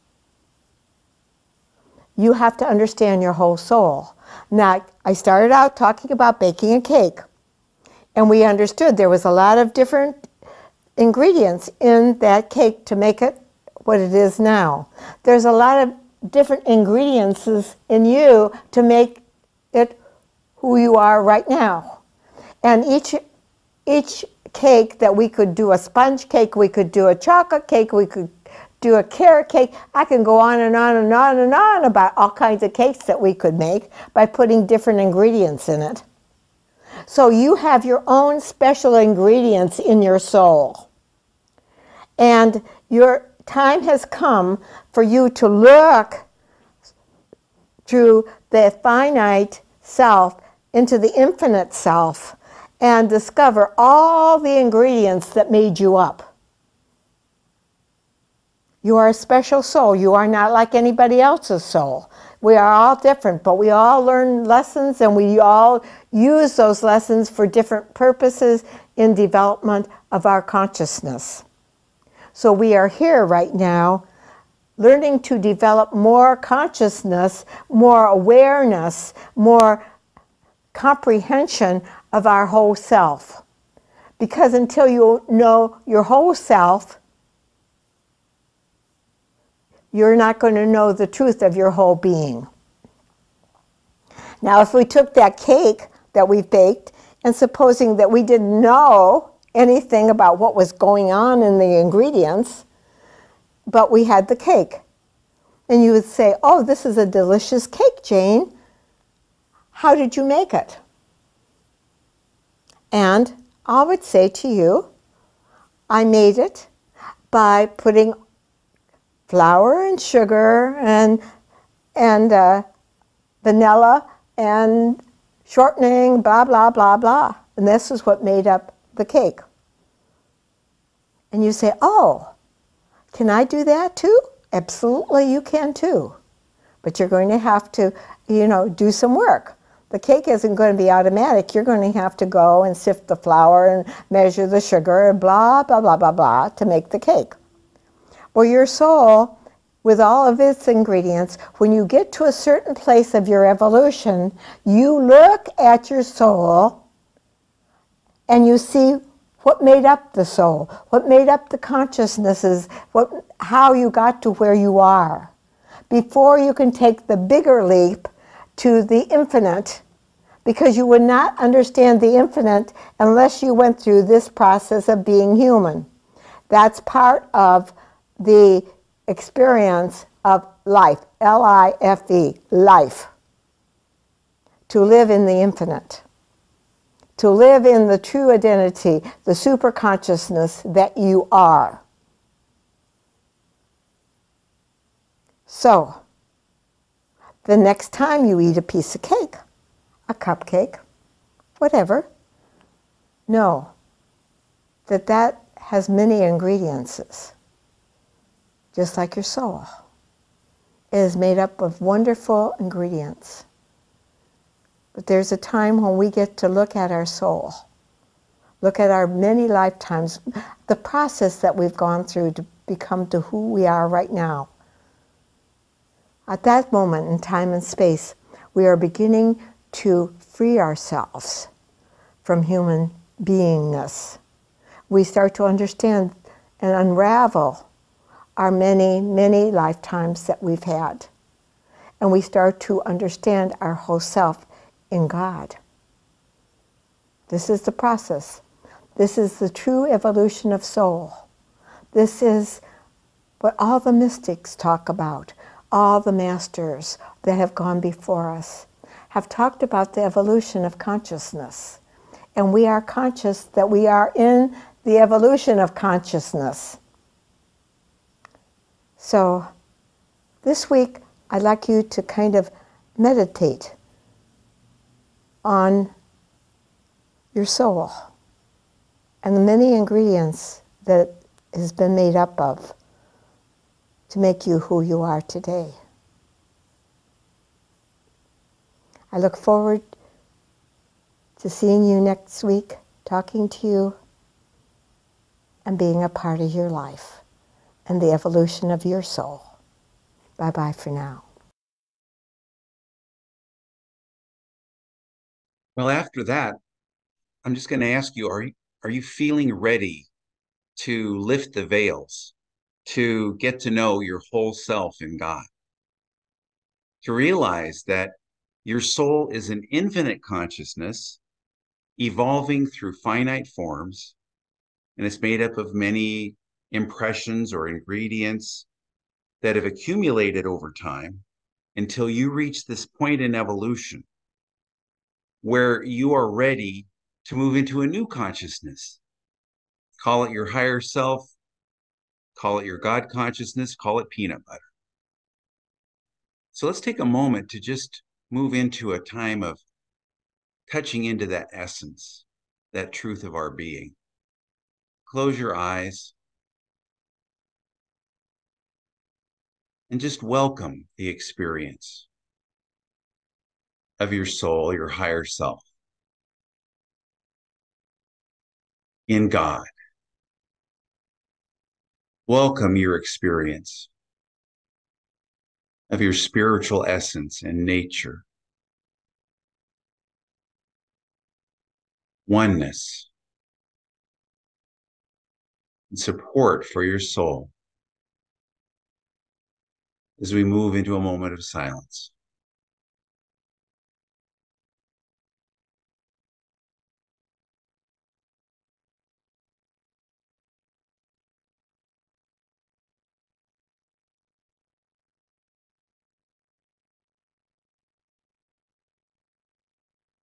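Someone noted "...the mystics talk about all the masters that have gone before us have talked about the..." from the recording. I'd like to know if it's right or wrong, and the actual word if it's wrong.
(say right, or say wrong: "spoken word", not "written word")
right.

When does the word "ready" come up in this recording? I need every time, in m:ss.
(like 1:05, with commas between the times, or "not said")
5:09, 5:36.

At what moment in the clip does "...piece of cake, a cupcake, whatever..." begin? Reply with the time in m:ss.
3:18.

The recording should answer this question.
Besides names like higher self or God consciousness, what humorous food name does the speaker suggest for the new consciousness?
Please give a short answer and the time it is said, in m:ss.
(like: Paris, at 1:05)
peanut butter, at 5:44.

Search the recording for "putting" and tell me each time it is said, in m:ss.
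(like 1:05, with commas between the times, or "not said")
0:34, 1:57.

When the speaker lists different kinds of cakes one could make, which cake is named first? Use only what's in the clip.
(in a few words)
sponge cake.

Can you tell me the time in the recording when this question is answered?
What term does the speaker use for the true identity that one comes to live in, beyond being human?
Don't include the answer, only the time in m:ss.
3:09.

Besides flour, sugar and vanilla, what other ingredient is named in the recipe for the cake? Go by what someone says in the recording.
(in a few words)
shortening.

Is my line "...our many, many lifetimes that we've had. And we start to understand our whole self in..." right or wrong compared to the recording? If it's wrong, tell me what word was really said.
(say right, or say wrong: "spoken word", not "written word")
right.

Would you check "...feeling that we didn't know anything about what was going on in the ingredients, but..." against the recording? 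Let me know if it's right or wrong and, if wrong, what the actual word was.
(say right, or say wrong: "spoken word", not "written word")
wrong: "supposing", not "feeling".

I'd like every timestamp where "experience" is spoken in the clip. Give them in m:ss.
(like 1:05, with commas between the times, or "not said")
2:59, 6:01, 6:12.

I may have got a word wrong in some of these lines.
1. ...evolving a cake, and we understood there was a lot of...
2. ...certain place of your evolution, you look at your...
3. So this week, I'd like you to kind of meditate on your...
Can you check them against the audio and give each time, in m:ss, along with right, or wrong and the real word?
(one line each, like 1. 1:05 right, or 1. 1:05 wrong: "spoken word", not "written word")
1. 0:06 wrong: "baking", not "evolving"
2. 2:32 right
3. 4:28 right.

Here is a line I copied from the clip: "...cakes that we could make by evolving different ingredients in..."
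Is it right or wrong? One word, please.
wrong.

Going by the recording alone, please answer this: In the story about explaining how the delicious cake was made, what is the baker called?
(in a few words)
Jane.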